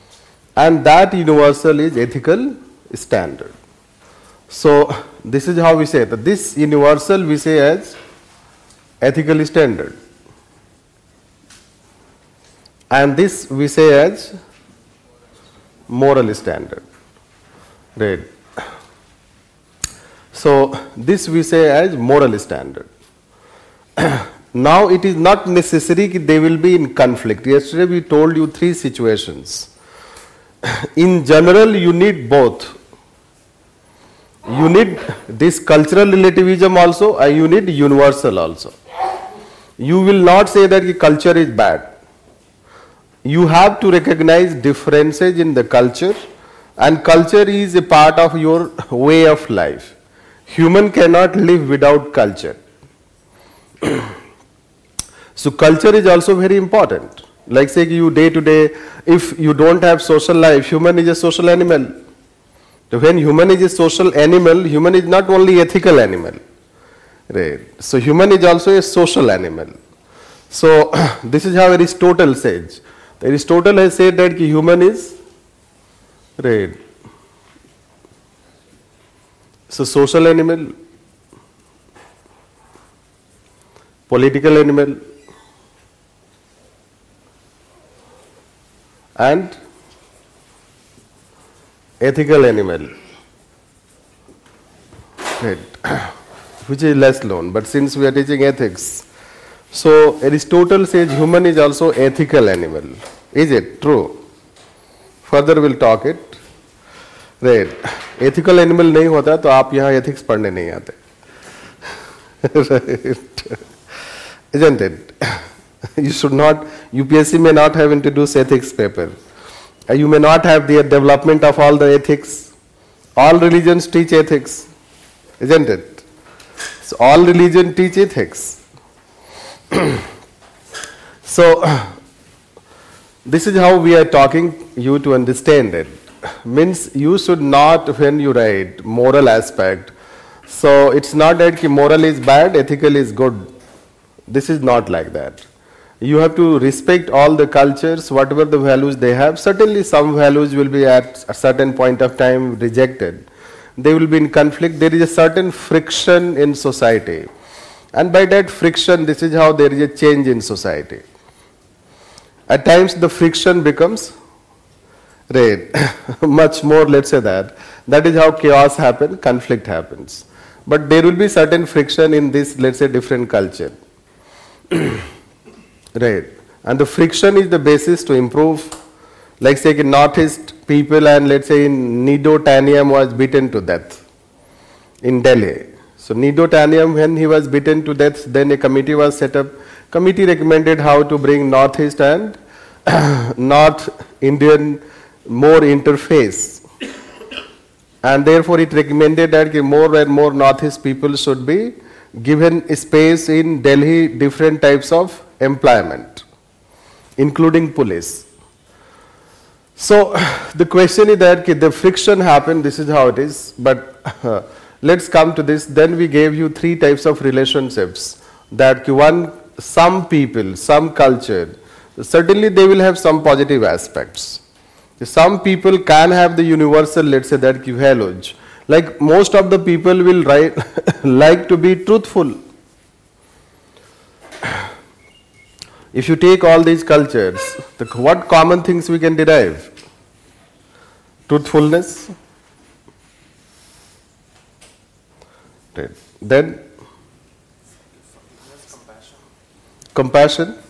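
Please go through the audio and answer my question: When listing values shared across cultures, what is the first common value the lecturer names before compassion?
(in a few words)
Truthfulness.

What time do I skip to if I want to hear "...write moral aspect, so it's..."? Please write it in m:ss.
2:18.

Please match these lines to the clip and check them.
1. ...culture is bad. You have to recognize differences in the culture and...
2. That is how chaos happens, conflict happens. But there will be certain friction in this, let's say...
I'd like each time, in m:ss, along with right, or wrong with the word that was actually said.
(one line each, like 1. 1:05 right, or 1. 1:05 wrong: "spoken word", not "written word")
1. 0:40 right
2. 2:47 right.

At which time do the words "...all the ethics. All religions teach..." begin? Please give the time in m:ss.
2:01.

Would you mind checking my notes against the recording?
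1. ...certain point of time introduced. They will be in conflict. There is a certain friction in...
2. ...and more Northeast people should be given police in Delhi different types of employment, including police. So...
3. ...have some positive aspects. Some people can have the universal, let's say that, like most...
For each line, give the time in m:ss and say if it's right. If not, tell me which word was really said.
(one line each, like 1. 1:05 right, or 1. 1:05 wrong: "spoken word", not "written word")
1. 2:31 wrong: "rejected", not "introduced"
2. 3:19 wrong: "space", not "police"
3. 3:42 right.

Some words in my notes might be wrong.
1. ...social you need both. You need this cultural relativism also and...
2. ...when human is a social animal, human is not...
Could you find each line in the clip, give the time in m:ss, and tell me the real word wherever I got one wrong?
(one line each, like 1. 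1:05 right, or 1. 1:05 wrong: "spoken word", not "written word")
1. 0:31 wrong: "general", not "social"
2. 1:02 right.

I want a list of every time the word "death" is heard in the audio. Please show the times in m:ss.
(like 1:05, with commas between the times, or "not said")
3:03, 3:07.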